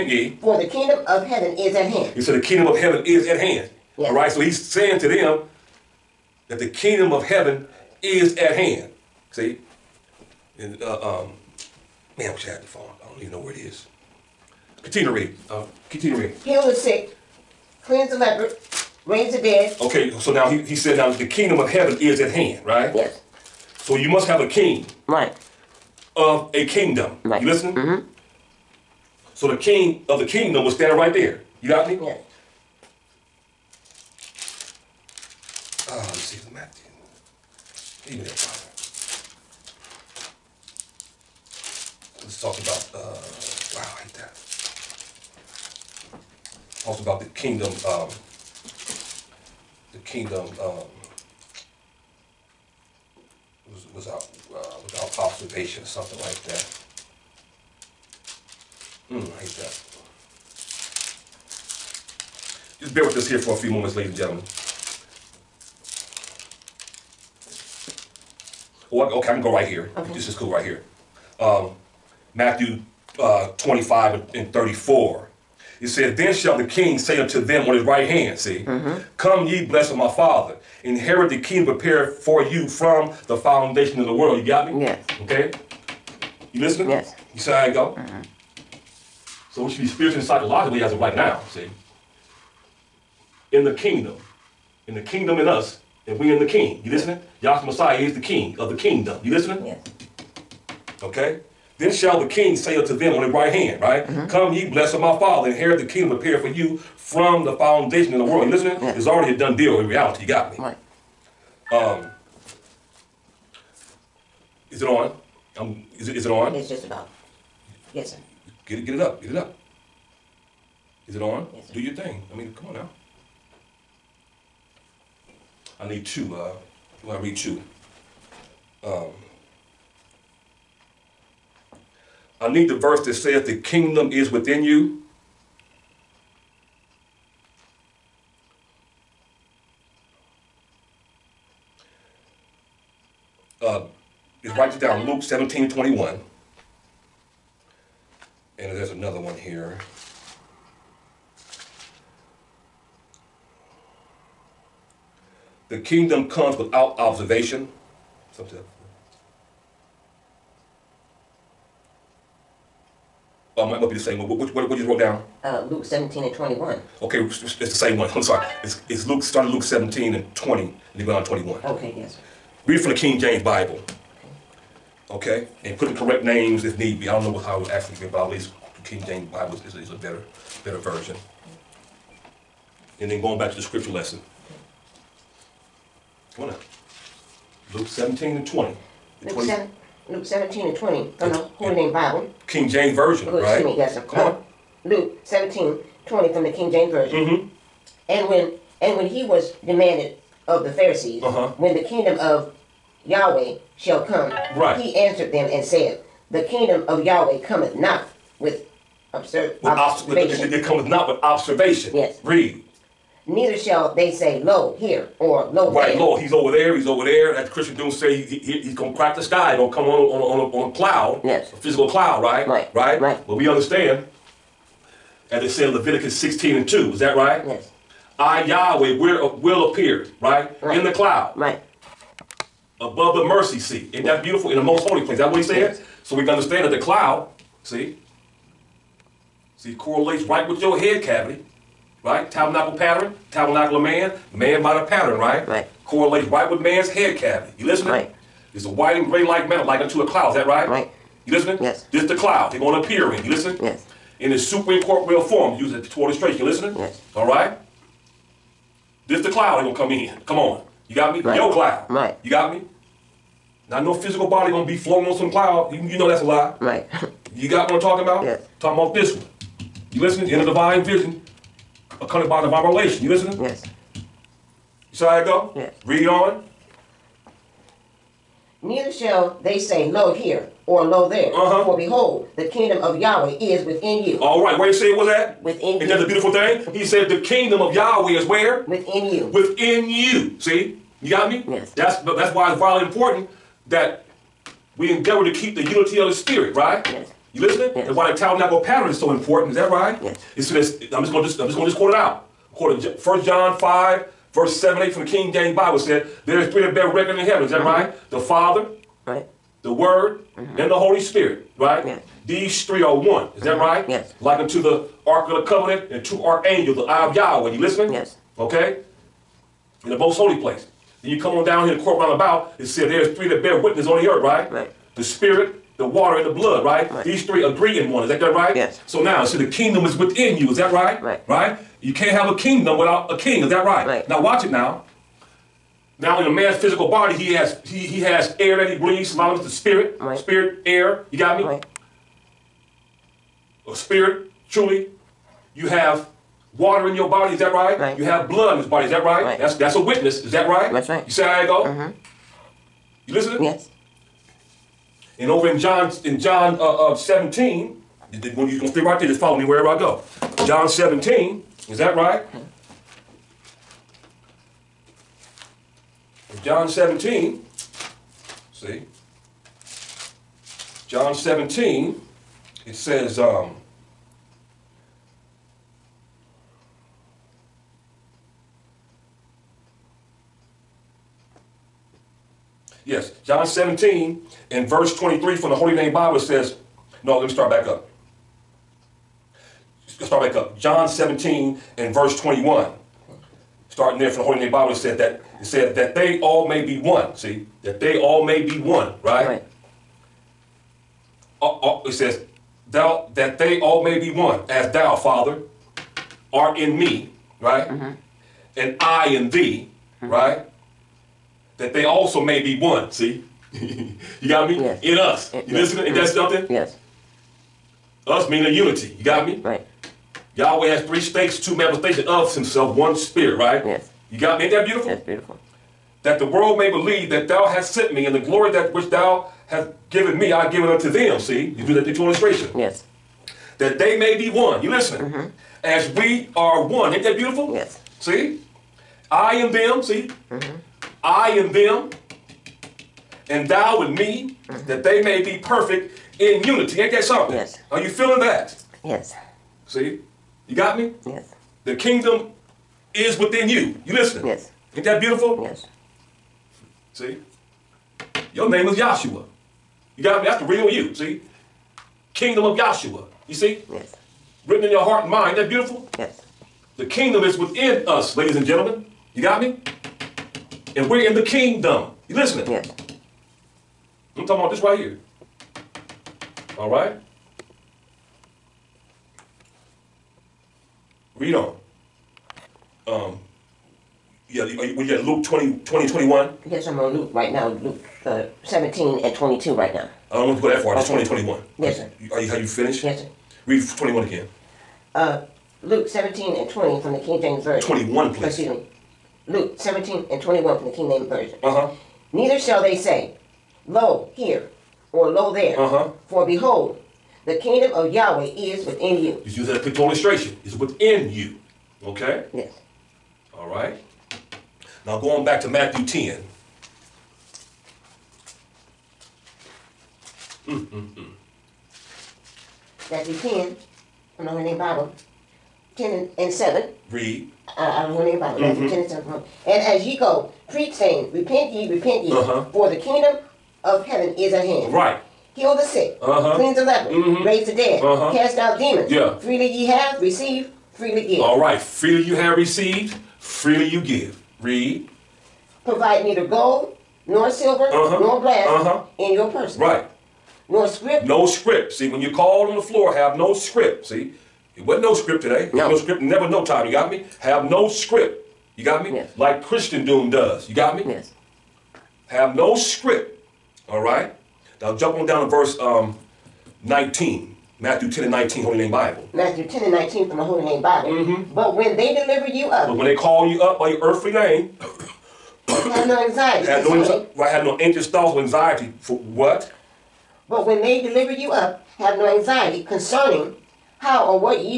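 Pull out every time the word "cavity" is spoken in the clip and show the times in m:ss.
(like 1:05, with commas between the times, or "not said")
4:01, 4:07.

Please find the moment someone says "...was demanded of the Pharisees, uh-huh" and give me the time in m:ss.
3:19.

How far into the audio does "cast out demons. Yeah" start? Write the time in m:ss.
8:58.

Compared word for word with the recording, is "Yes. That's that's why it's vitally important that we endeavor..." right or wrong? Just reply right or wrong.
right.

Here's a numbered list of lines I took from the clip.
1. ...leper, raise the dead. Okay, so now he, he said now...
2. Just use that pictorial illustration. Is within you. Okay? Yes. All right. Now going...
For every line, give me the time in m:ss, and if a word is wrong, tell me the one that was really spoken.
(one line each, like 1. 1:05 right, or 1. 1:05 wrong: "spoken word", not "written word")
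1. 0:18 right
2. 8:29 right.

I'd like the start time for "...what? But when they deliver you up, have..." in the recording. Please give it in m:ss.
9:38.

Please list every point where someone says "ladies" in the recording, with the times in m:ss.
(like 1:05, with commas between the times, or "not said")
1:03, 7:48.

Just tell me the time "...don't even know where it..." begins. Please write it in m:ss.
0:13.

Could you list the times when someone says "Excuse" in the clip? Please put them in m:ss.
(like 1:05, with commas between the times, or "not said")
3:13, 8:18.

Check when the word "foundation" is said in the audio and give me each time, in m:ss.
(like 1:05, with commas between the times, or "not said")
1:23, 1:47.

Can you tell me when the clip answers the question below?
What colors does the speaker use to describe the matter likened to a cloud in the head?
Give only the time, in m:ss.
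4:08.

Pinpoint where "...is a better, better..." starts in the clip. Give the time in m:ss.
2:59.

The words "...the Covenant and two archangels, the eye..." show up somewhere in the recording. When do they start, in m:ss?
5:15.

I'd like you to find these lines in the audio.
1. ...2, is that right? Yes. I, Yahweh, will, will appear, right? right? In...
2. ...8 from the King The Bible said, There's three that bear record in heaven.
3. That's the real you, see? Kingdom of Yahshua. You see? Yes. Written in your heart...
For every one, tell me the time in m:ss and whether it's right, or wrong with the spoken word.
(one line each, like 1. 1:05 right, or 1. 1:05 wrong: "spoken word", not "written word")
1. 3:46 right
2. 5:04 wrong: "James", not "The"
3. 7:40 right.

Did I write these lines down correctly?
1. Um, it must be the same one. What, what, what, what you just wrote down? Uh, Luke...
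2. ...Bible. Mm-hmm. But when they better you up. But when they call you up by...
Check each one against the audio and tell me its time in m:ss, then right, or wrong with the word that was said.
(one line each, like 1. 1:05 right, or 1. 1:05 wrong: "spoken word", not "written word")
1. 2:43 right
2. 9:30 wrong: "deliver", not "better".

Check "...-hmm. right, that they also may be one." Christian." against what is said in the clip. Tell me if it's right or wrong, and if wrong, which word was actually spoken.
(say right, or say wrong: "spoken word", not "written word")
wrong: "See", not "Christian".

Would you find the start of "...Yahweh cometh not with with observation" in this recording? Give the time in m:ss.
3:27.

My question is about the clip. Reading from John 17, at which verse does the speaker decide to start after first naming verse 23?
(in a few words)
21.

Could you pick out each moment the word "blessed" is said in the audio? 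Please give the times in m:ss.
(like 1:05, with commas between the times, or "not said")
1:19, 1:44.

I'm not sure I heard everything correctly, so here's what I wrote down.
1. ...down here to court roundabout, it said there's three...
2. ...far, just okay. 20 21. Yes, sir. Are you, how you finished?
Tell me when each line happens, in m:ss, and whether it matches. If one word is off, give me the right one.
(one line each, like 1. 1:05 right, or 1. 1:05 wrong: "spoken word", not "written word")
1. 5:21 right
2. 8:10 right.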